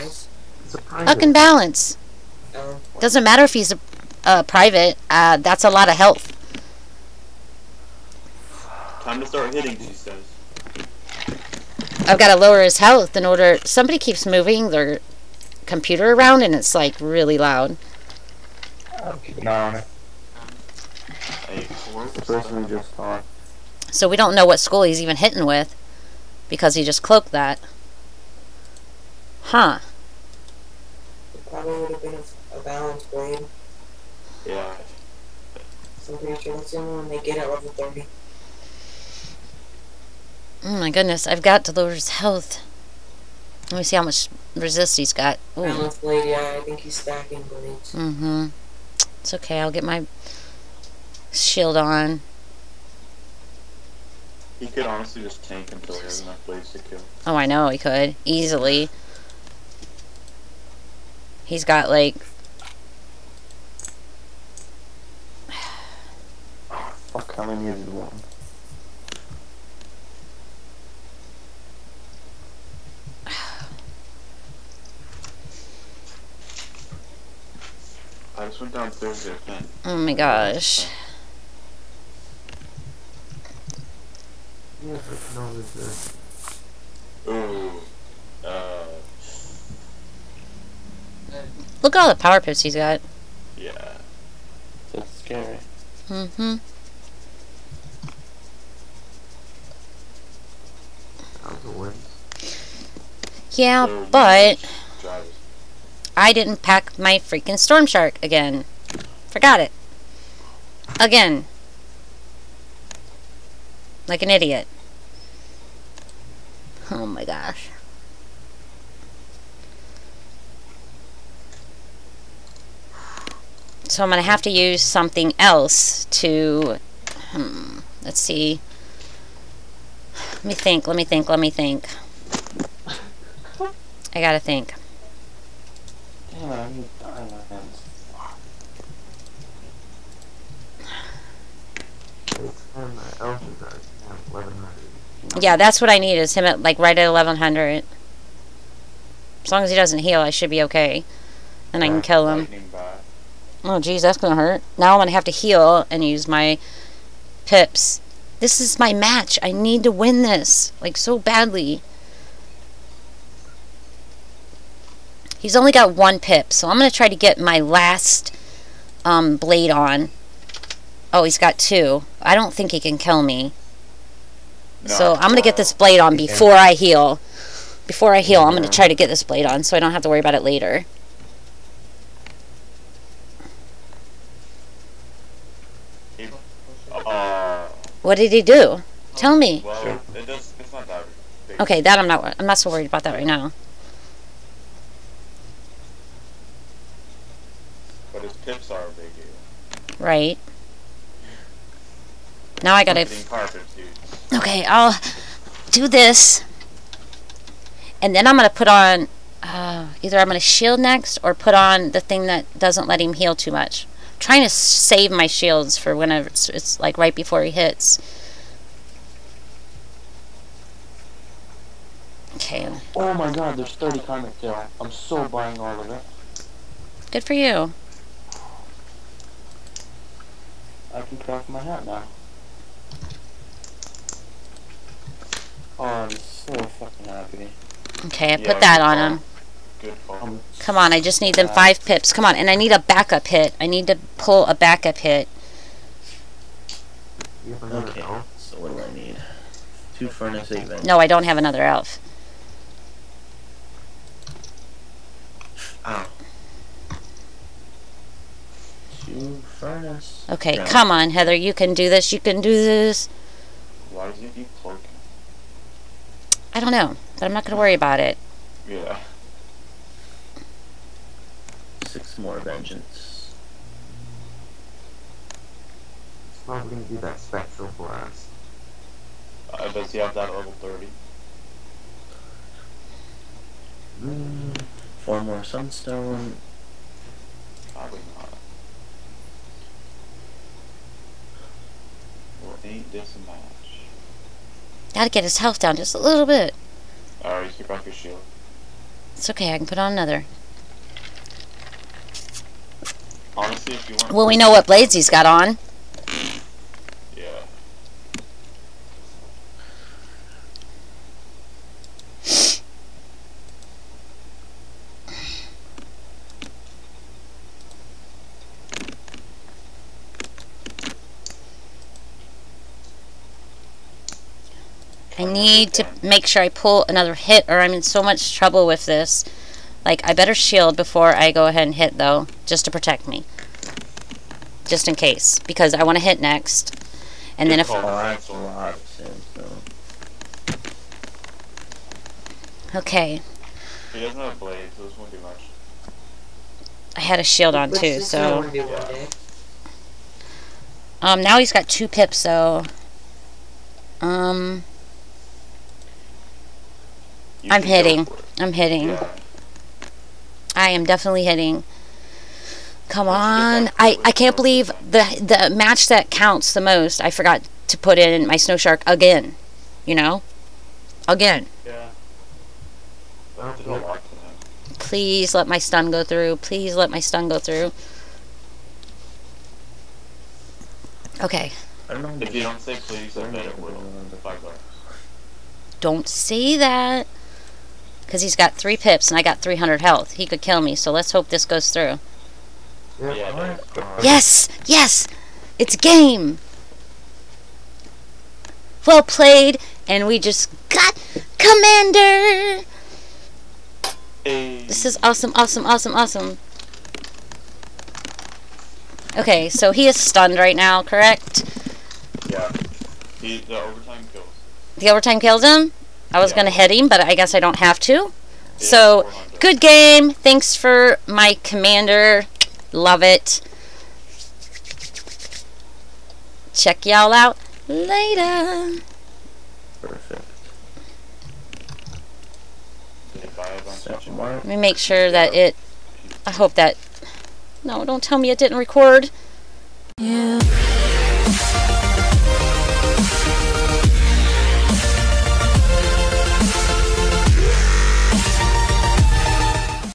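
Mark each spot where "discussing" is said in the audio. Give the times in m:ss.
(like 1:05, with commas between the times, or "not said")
not said.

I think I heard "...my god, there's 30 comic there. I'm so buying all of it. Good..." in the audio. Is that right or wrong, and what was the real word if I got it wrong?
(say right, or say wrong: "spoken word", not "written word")
right.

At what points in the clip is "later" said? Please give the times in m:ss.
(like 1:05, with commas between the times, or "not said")
3:00, 7:07.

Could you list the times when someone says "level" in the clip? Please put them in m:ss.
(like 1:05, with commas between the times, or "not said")
0:37, 4:40.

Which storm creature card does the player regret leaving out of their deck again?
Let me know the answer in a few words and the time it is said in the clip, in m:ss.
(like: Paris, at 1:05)
Storm Shark, at 1:47.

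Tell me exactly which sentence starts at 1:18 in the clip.
I just went down Thursday again.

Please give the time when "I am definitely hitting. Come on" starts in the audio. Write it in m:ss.
6:00.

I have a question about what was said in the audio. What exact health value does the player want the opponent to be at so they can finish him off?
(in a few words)
1100.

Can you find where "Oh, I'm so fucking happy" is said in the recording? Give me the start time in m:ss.
3:55.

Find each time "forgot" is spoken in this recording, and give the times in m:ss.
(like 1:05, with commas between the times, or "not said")
1:49, 6:07.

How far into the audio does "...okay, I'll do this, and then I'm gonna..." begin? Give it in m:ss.
3:24.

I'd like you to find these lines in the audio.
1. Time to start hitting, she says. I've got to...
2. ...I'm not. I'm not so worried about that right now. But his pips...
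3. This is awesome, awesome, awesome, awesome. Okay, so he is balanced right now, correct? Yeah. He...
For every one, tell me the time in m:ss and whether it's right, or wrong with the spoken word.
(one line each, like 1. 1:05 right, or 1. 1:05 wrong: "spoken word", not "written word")
1. 0:09 right
2. 3:11 right
3. 6:44 wrong: "stunned", not "balanced".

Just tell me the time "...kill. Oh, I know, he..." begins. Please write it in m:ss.
0:56.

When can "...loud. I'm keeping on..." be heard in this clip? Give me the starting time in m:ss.
0:17.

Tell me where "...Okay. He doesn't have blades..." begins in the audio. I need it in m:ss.
5:42.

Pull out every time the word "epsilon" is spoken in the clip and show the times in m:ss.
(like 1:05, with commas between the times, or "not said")
not said.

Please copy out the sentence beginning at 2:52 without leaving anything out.
I don't think he can kill me.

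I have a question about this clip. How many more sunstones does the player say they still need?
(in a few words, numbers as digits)
4.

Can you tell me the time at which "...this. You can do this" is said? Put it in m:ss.
4:21.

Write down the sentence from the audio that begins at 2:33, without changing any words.
Oh, geez, that's going to hurt.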